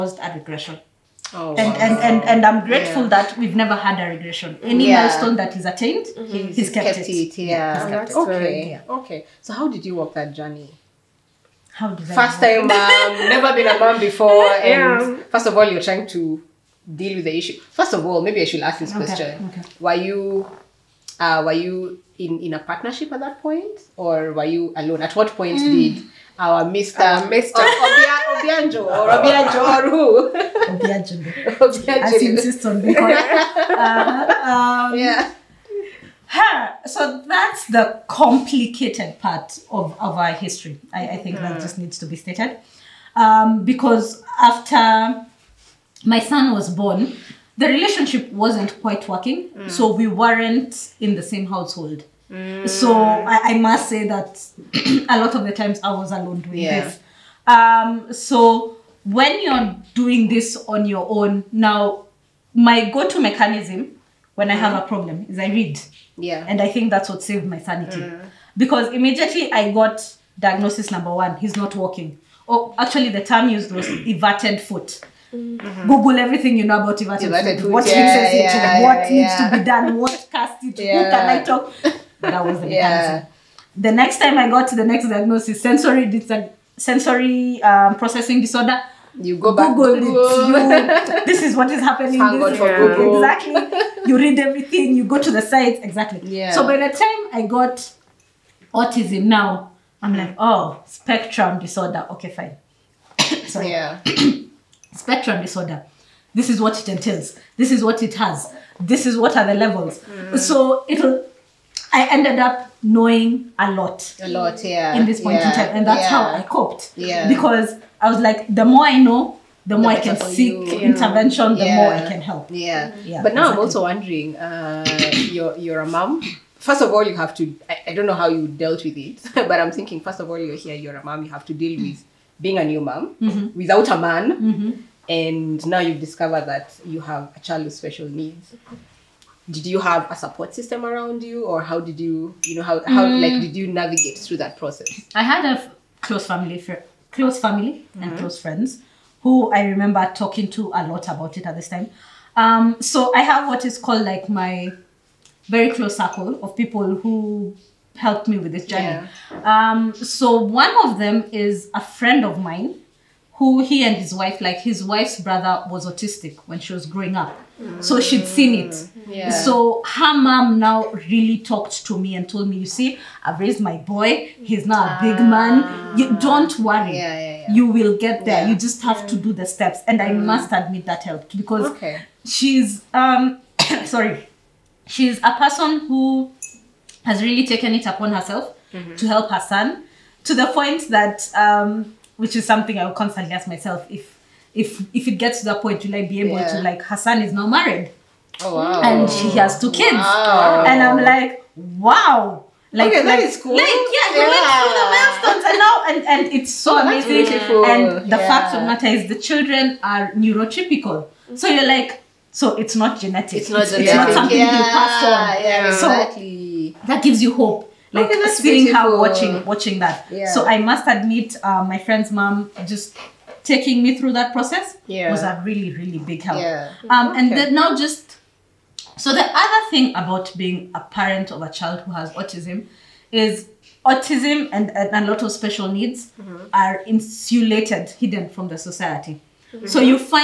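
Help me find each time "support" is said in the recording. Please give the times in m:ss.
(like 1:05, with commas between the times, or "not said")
2:20.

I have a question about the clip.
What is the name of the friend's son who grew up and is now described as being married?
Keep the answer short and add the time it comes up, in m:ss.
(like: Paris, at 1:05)
Hassan, at 3:16.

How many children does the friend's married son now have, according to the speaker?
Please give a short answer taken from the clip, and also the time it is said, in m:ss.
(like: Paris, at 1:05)
2, at 3:19.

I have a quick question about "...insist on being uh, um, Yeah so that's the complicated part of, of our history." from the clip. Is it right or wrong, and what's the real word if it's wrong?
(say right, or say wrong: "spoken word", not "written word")
right.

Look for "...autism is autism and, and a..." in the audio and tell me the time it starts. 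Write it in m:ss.
3:52.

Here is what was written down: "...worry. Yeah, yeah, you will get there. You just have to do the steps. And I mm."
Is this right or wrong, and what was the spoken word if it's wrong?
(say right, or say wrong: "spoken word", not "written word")
right.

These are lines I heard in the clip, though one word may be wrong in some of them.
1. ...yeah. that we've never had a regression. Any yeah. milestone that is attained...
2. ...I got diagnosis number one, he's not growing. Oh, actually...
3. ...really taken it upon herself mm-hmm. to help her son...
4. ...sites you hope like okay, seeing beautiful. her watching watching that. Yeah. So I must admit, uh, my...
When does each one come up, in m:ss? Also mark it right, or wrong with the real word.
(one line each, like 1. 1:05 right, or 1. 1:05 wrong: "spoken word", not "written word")
1. 0:03 right
2. 1:09 wrong: "walking", not "growing"
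3. 3:07 right
4. 3:37 wrong: "gives", not "sites".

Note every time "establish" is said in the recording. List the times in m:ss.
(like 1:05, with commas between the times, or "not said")
not said.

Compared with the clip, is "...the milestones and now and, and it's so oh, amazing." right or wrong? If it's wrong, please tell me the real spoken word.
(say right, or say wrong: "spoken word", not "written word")
right.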